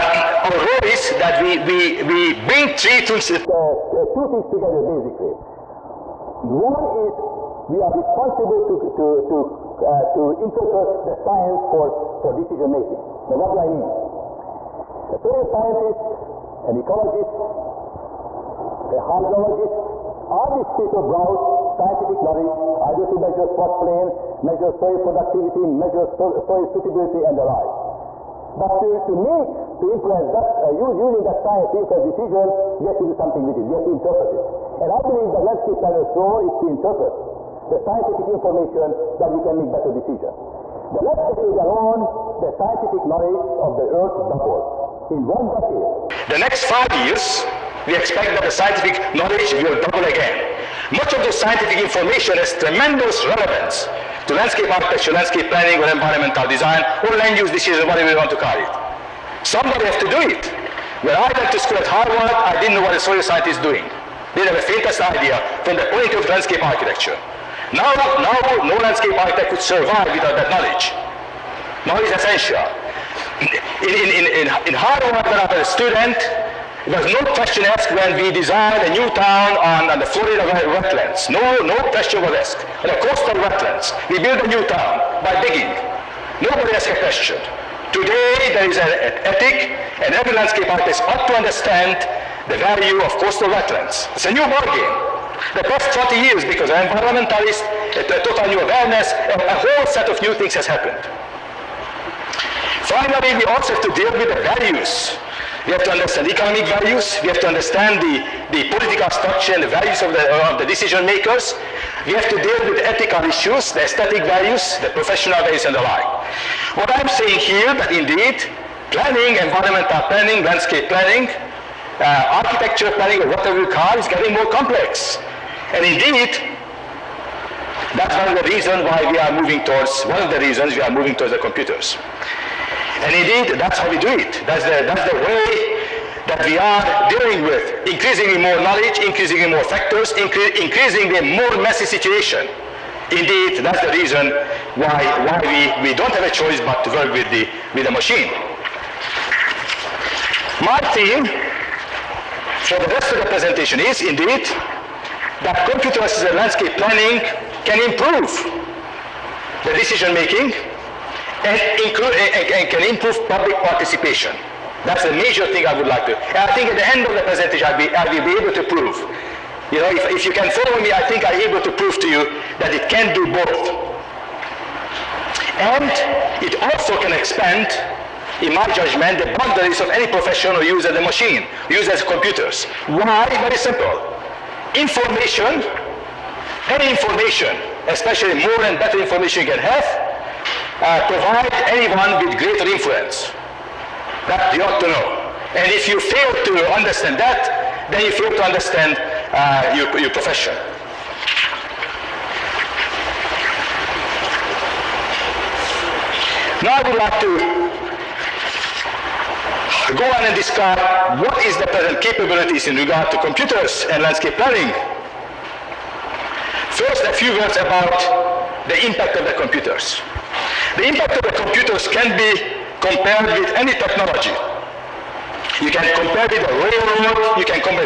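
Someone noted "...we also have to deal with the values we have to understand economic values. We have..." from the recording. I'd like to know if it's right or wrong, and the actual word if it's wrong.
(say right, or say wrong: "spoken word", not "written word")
right.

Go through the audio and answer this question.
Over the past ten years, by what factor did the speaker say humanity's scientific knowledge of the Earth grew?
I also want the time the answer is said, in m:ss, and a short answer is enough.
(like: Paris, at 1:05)
doubled, at 0:44.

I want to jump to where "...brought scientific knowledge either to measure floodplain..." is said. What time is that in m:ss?
0:21.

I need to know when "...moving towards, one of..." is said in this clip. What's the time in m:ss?
2:09.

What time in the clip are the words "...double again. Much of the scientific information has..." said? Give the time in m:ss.
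0:49.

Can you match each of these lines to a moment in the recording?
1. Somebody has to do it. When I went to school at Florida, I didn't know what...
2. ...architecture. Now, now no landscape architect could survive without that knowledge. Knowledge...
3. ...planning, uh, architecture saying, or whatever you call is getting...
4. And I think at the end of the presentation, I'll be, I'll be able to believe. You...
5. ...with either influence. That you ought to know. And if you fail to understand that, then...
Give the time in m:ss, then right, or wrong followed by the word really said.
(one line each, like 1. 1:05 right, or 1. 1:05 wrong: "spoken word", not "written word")
1. 0:59 wrong: "Harvard", not "Florida"
2. 1:06 right
3. 2:00 wrong: "planning", not "saying"
4. 2:46 wrong: "prove", not "believe"
5. 3:12 wrong: "greater", not "either".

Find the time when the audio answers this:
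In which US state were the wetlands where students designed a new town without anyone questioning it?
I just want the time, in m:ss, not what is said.
1:20.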